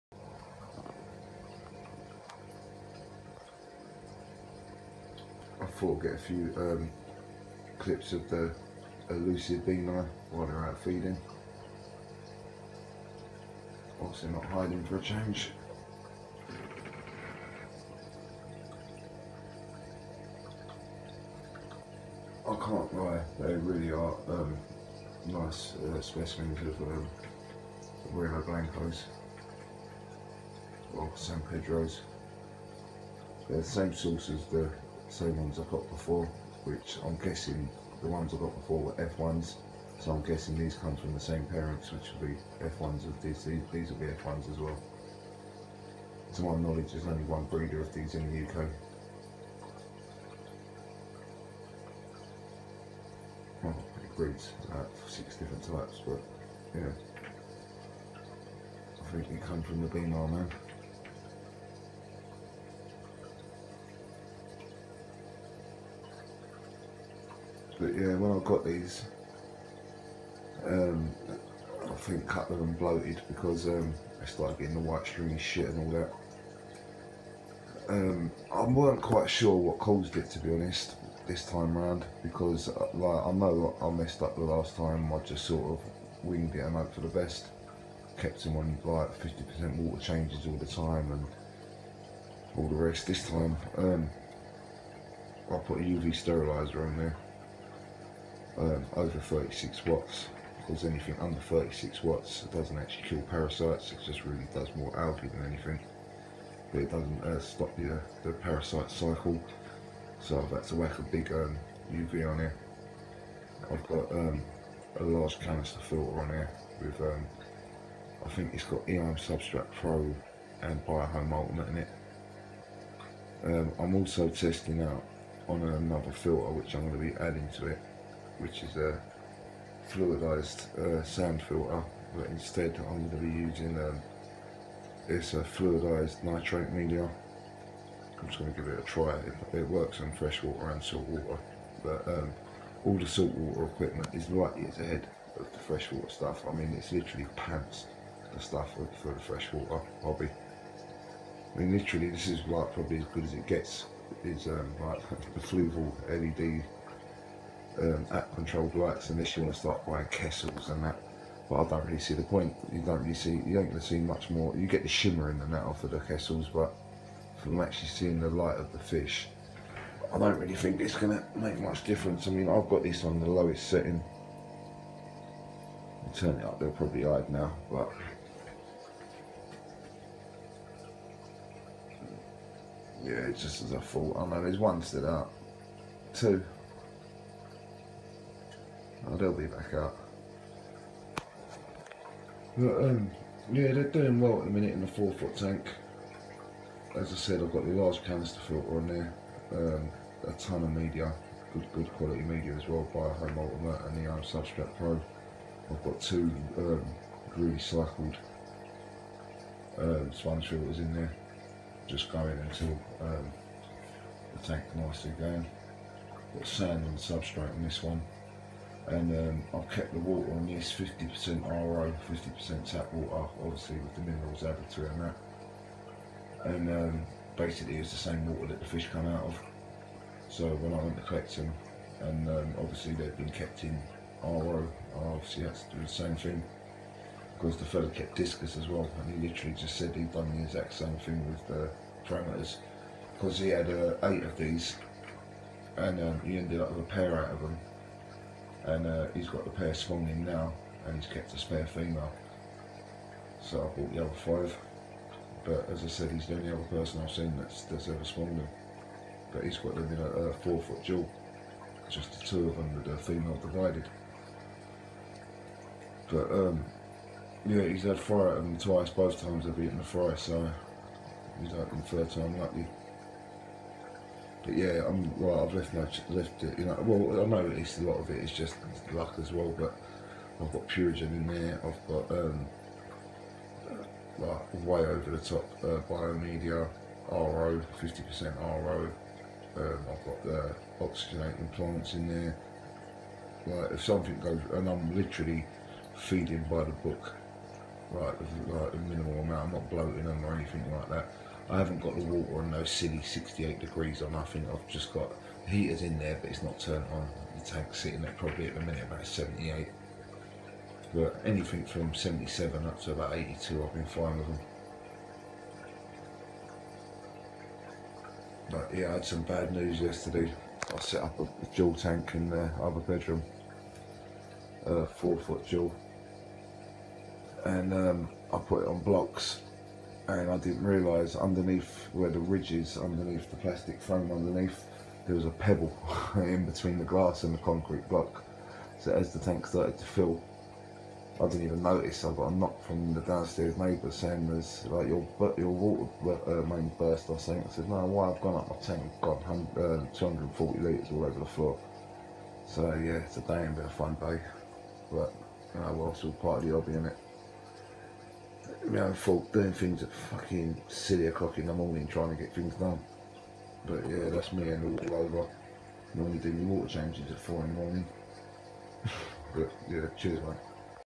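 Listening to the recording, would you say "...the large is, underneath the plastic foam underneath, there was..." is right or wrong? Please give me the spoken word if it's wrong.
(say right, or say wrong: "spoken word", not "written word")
wrong: "ridge", not "large".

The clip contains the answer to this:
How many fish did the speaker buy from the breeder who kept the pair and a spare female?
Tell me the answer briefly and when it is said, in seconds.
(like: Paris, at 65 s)
5, at 254 s.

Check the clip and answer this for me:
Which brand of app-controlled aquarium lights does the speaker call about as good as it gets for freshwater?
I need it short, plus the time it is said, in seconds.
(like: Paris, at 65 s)
Fluval, at 155 s.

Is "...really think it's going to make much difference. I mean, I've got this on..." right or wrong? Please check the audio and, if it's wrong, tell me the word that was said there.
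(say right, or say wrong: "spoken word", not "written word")
right.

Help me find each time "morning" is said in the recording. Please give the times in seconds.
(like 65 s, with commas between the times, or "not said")
361 s, 367 s.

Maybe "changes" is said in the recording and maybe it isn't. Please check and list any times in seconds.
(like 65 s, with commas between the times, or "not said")
15 s, 90 s, 366 s.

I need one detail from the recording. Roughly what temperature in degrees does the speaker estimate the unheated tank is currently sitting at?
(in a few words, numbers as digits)
78.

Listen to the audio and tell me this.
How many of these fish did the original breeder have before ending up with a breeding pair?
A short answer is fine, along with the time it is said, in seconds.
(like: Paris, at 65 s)
8, at 244 s.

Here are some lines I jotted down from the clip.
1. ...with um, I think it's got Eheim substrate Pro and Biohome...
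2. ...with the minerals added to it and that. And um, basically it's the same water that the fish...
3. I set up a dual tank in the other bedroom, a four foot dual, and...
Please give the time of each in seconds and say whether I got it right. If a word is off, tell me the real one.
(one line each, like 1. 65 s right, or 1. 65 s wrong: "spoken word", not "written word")
1. 116 s right
2. 223 s right
3. 320 s right.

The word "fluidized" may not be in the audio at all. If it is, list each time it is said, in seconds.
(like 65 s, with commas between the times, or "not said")
129 s, 135 s.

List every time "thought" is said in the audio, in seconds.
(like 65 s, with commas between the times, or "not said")
5 s, 183 s.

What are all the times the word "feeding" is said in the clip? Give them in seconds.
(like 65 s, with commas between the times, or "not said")
10 s, 295 s.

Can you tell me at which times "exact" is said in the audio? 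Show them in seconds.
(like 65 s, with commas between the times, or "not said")
240 s.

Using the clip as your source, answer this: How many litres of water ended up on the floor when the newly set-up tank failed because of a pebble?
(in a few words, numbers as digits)
240 litres.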